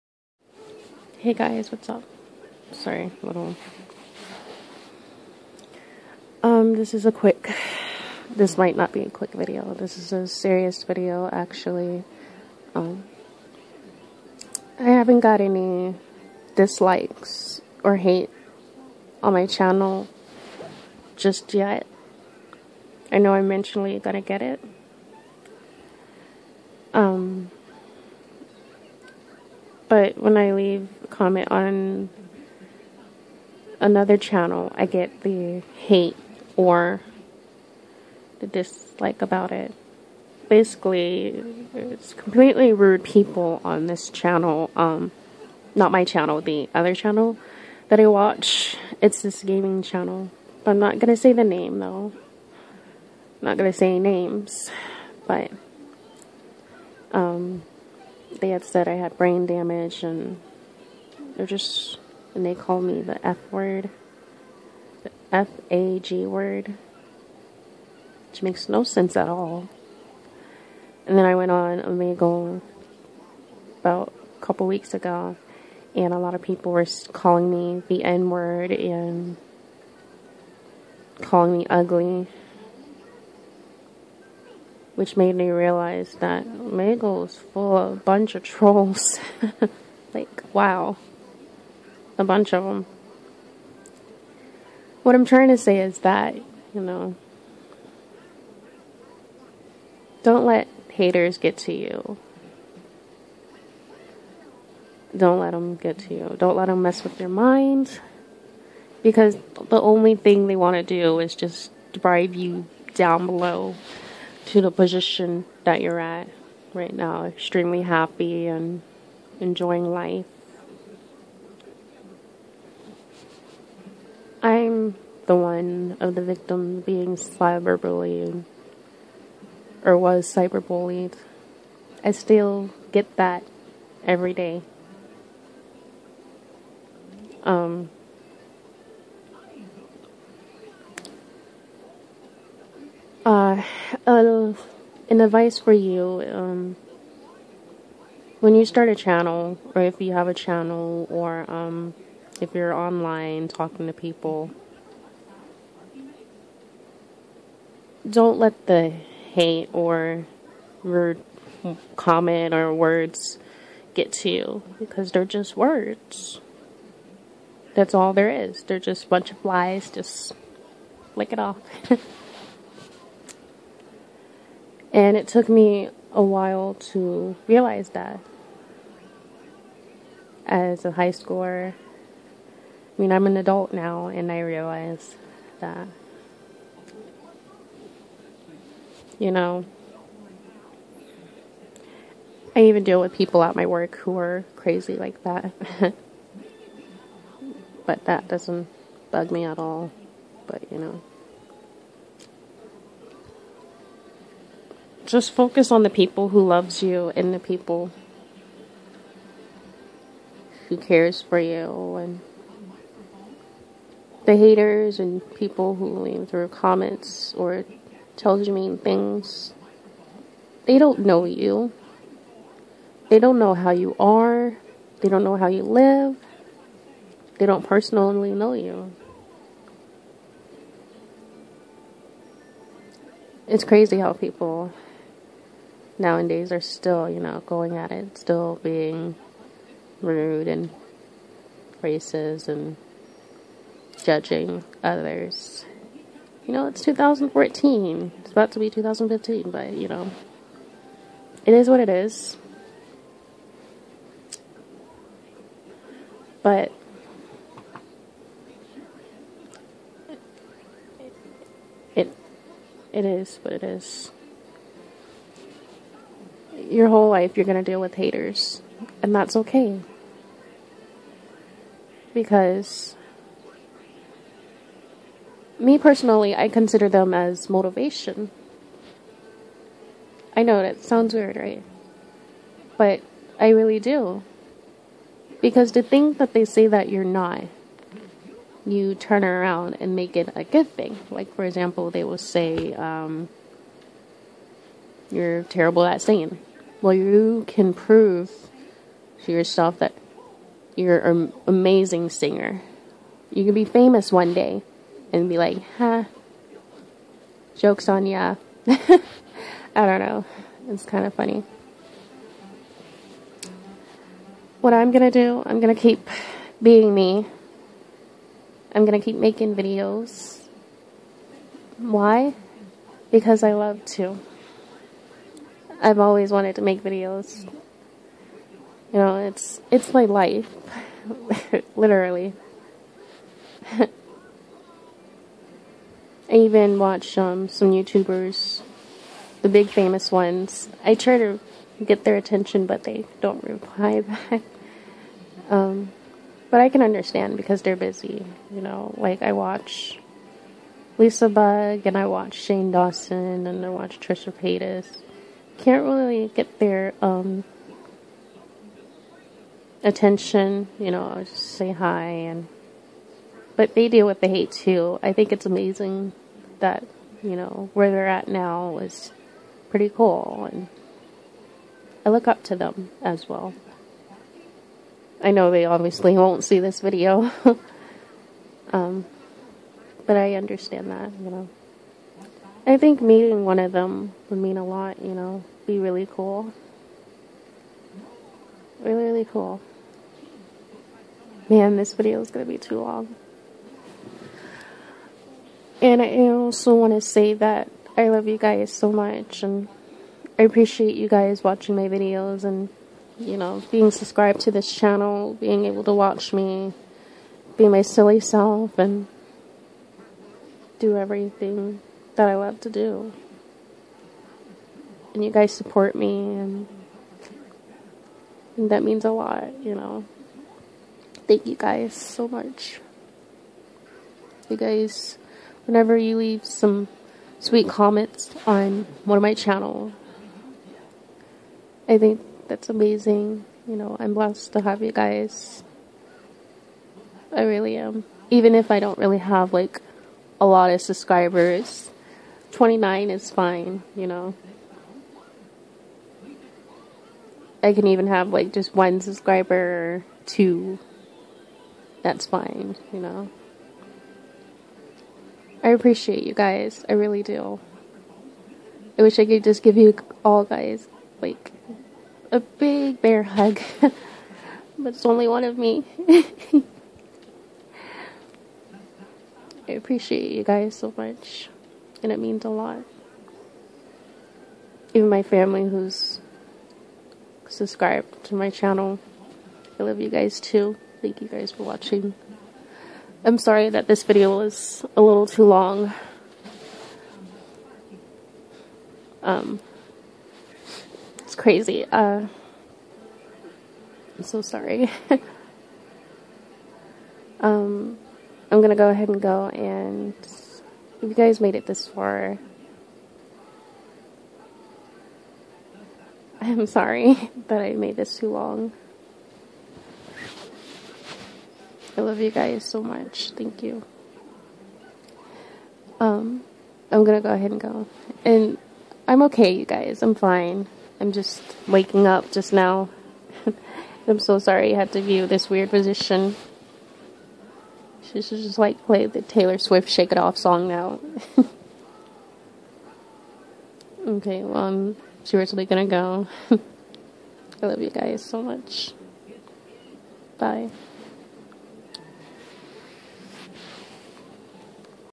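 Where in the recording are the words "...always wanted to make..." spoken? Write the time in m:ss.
5:25.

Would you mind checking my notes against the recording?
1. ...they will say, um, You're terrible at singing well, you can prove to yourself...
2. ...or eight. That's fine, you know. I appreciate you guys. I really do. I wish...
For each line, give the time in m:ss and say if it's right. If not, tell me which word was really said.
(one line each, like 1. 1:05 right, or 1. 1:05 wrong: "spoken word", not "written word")
1. 4:51 right
2. 7:29 wrong: "two", not "eight".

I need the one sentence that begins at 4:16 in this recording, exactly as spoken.
But it it is what it is your whole life you're going to deal with haters.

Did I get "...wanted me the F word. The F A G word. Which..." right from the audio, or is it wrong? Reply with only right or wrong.
wrong.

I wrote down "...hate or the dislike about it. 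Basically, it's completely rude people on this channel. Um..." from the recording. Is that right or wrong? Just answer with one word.
right.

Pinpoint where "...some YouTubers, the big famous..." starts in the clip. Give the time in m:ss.
5:37.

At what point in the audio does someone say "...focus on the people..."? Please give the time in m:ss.
3:25.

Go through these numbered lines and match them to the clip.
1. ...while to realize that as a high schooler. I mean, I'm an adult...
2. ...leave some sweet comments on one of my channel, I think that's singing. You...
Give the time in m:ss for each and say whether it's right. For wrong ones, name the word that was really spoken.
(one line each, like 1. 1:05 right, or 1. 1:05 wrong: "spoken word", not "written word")
1. 2:56 right
2. 7:06 wrong: "amazing", not "singing".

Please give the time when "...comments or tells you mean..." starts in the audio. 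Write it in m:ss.
3:36.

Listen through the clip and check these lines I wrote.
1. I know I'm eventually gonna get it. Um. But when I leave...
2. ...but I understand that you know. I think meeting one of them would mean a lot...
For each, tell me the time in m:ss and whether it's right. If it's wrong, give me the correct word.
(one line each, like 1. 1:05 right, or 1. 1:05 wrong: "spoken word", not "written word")
1. 0:23 right
2. 6:20 right.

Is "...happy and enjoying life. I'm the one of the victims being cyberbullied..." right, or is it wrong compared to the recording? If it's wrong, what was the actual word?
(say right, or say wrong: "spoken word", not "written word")
right.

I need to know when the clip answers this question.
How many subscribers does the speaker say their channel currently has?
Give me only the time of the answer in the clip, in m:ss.
7:22.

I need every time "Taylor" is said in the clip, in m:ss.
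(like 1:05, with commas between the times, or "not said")
8:49.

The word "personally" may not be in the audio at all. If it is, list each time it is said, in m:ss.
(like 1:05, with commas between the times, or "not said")
3:47, 4:35.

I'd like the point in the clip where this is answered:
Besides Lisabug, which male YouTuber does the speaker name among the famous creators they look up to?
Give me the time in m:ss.
5:52.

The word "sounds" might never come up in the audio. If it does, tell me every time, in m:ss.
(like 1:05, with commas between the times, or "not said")
4:40.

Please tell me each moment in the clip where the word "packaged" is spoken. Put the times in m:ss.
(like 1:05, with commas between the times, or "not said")
not said.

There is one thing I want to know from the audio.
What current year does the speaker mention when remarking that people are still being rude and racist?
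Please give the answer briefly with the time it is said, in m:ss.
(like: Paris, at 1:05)
2014, at 4:06.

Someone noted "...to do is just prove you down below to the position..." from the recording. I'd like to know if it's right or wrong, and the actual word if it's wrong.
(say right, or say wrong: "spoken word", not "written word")
wrong: "drive", not "prove".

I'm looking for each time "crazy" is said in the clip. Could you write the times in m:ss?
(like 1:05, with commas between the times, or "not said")
3:14, 3:53, 8:11.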